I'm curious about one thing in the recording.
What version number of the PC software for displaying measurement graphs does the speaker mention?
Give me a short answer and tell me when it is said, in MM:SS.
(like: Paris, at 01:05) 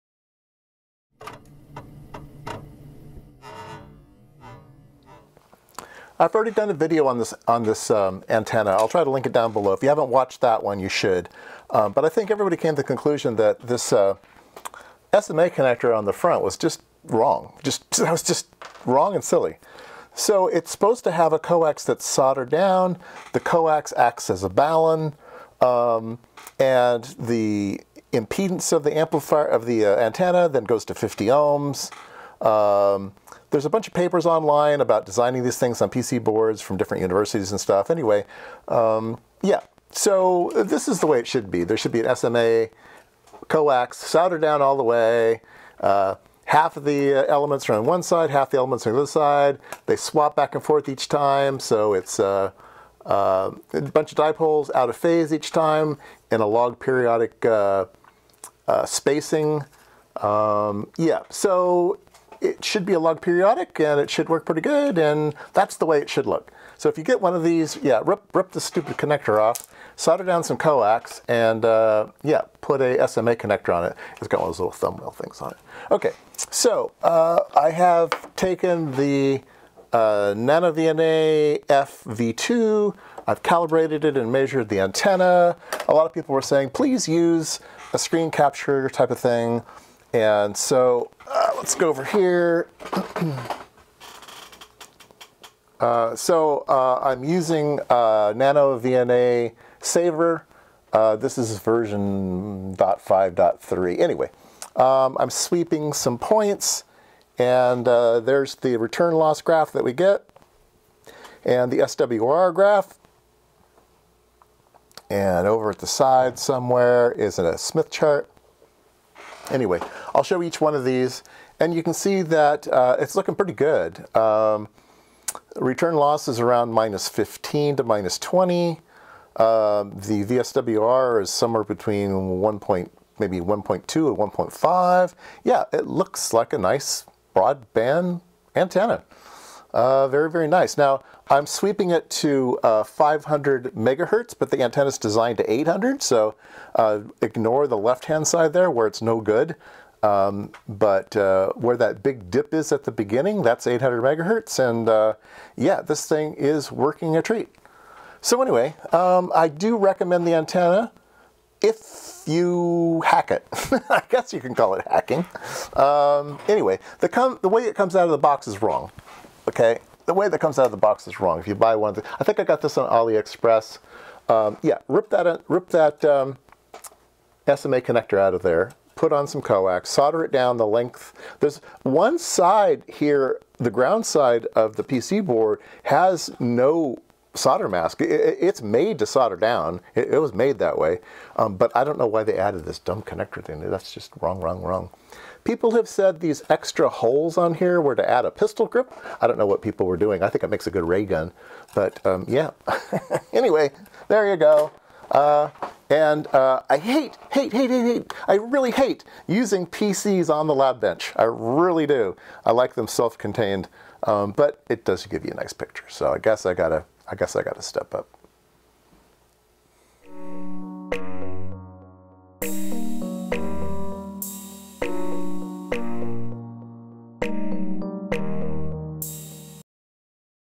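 .5.3, at 01:42.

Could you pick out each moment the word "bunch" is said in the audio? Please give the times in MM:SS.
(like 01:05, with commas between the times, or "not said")
00:33, 00:53.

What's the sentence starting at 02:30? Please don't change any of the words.
Um, but uh, where that big dip is at the beginning, that's 800 megahertz.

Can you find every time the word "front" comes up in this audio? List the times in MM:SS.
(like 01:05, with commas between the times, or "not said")
00:16.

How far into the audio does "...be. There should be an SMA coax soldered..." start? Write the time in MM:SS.
00:41.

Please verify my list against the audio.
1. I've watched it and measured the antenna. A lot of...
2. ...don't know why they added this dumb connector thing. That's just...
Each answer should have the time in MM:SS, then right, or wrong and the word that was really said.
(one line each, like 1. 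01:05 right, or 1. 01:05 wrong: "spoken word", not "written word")
1. 01:23 wrong: "calibrated", not "watched"
2. 03:11 right.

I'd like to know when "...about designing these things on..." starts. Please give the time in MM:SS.
00:34.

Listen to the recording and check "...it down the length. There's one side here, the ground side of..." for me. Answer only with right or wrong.
right.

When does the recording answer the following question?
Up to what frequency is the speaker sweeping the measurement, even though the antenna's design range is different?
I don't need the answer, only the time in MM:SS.
02:22.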